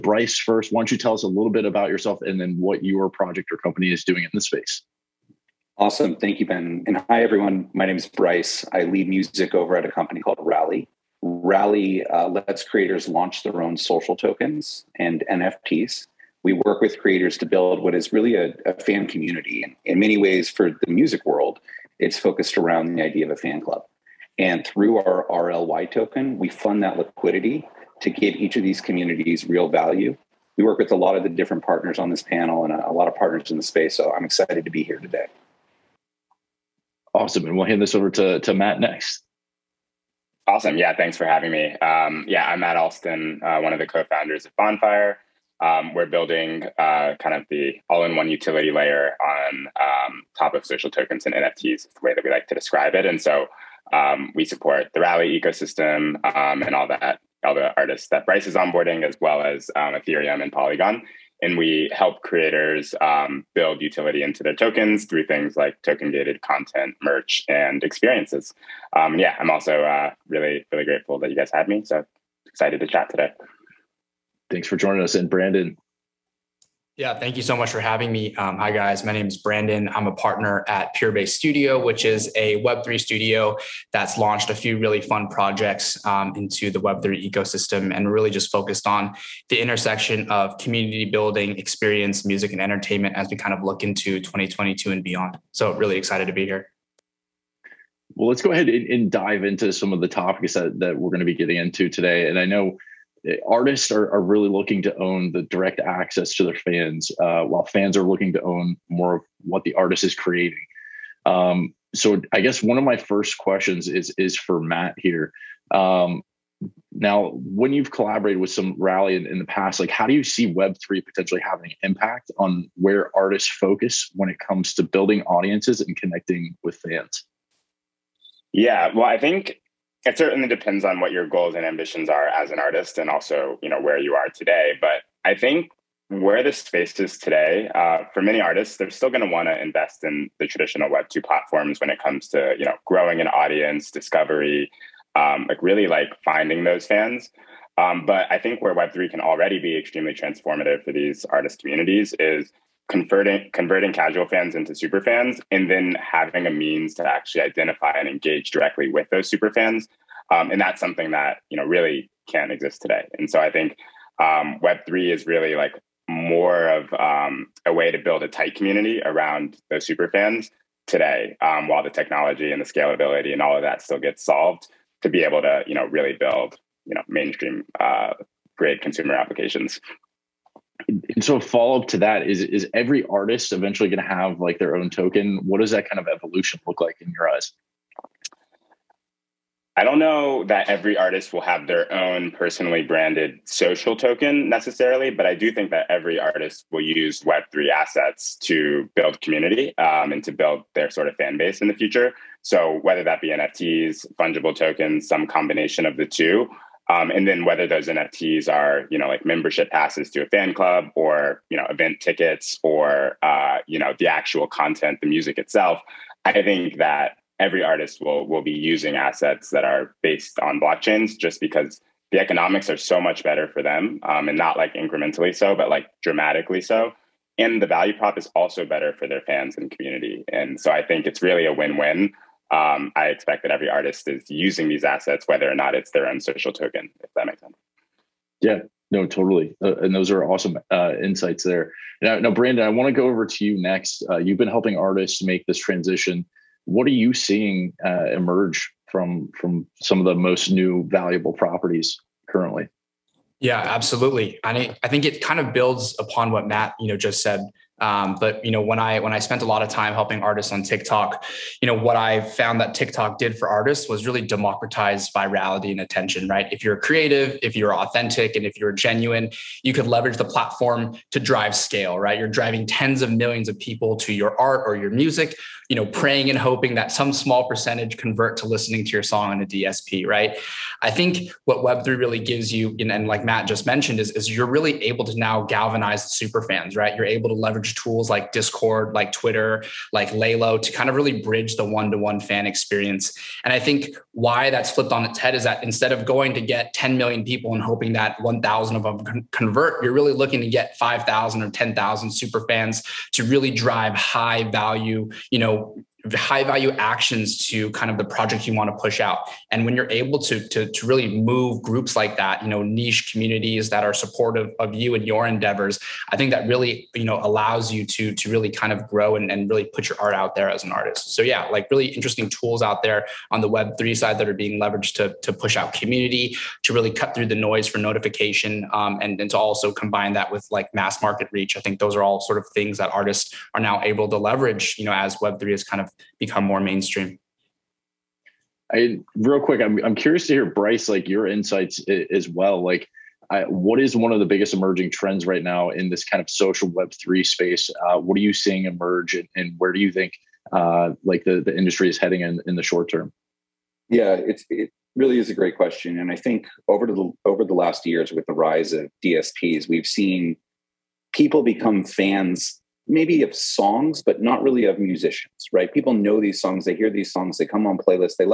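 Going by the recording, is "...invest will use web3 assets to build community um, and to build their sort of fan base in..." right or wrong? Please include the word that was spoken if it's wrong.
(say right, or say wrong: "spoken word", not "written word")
wrong: "artist", not "invest".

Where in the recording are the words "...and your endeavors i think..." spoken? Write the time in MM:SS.
05:14.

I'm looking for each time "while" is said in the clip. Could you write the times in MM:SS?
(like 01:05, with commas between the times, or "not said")
01:47, 02:51.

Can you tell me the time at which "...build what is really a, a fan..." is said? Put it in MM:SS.
00:17.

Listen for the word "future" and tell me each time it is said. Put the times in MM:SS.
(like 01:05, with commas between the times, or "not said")
03:21.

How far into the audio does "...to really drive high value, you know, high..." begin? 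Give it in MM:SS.
05:03.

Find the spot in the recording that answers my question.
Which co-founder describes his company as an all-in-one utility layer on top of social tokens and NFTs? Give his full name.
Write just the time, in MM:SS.
00:42.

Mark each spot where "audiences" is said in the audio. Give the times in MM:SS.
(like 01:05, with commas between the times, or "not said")
02:05, 02:23.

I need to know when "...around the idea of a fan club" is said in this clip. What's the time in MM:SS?
00:22.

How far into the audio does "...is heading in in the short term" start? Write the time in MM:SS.
05:51.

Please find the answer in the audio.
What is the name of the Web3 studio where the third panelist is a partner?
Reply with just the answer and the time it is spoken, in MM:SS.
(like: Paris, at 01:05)
Purebase Studio, at 01:20.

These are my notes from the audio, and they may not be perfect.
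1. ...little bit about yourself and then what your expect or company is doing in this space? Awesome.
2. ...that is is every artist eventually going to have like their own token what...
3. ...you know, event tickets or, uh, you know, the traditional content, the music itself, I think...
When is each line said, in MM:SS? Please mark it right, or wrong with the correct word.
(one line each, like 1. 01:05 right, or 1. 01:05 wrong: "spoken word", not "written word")
1. 00:01 wrong: "project", not "expect"
2. 03:01 right
3. 03:31 wrong: "actual", not "traditional".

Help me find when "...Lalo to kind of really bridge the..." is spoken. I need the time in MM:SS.
04:50.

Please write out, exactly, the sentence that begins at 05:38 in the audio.
I real quick, I'm I'm curious to hear Bryce like your insights as well.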